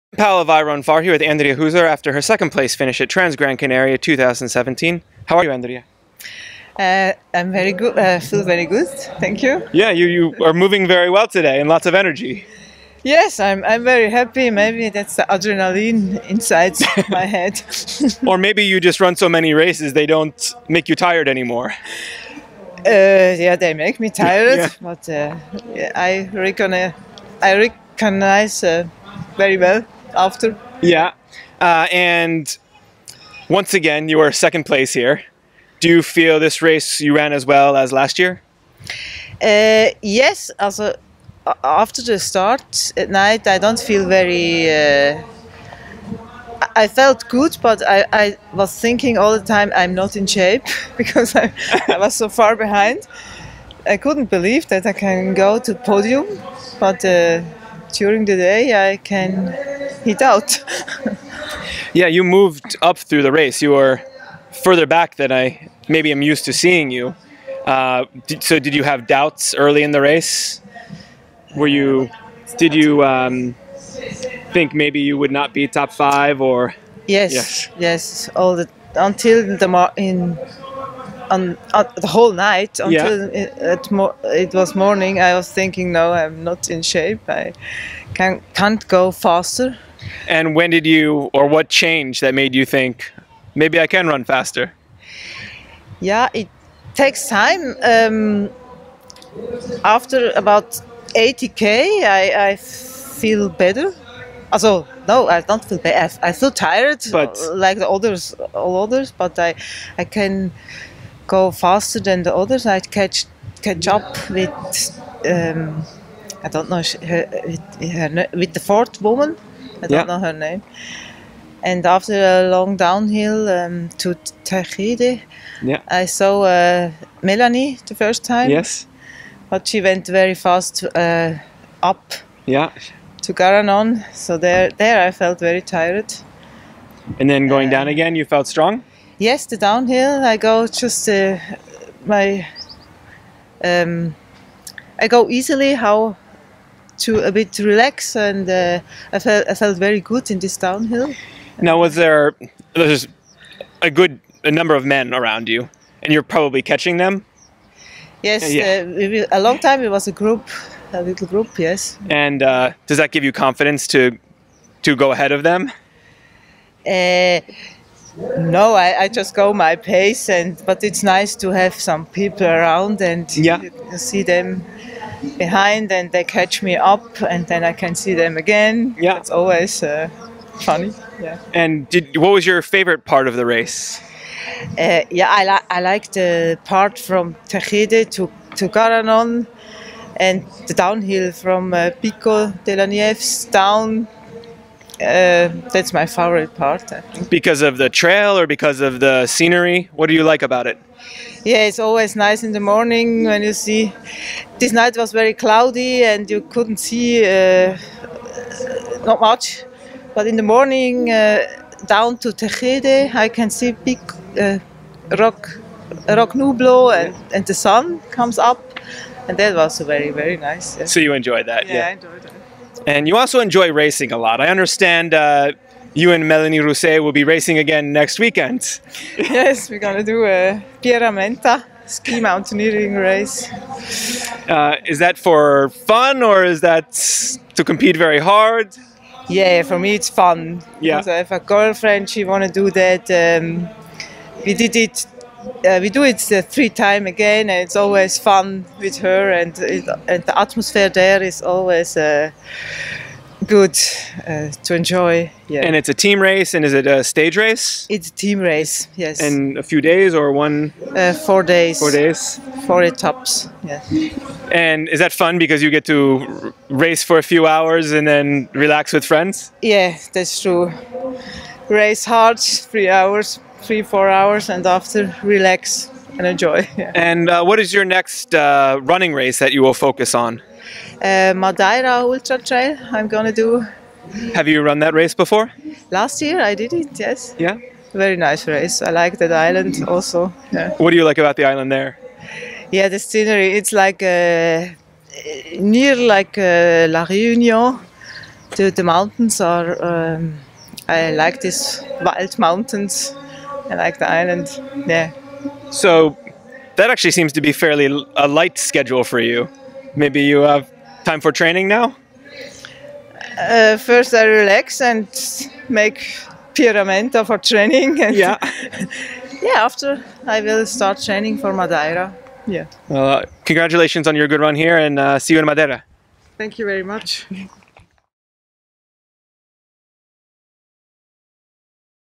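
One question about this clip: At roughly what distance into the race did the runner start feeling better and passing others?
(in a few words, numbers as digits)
80k.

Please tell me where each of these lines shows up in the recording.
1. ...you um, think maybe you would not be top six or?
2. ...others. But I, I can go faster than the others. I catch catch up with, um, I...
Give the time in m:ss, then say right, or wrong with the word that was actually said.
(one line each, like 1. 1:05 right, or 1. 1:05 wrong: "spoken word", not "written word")
1. 1:12 wrong: "five", not "six"
2. 1:48 right.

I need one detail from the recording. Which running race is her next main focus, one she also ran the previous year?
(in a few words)
Madeira Ultra Trail.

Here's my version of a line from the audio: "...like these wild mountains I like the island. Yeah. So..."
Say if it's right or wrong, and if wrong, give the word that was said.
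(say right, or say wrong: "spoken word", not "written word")
right.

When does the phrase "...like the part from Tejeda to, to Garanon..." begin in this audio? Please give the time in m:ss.
3:05.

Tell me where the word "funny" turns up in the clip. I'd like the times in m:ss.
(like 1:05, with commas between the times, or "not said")
3:00.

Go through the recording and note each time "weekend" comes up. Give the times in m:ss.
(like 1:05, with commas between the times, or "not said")
3:48.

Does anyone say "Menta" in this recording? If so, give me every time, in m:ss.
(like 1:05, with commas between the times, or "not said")
3:50, 5:16.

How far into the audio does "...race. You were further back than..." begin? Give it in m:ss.
1:03.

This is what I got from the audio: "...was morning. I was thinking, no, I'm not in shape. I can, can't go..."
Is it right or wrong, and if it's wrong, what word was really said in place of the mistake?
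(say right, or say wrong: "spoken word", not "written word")
right.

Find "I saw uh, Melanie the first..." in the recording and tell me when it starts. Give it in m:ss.
2:05.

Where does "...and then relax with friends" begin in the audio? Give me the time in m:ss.
4:27.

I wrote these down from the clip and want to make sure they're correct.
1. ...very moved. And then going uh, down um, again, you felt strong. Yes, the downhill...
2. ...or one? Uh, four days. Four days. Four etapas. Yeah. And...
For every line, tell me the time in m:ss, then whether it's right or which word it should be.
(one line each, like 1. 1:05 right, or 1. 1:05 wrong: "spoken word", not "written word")
1. 2:15 wrong: "tired", not "moved"
2. 4:20 right.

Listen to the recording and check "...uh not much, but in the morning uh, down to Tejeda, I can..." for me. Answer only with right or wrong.
right.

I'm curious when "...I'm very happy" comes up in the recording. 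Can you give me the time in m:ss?
0:13.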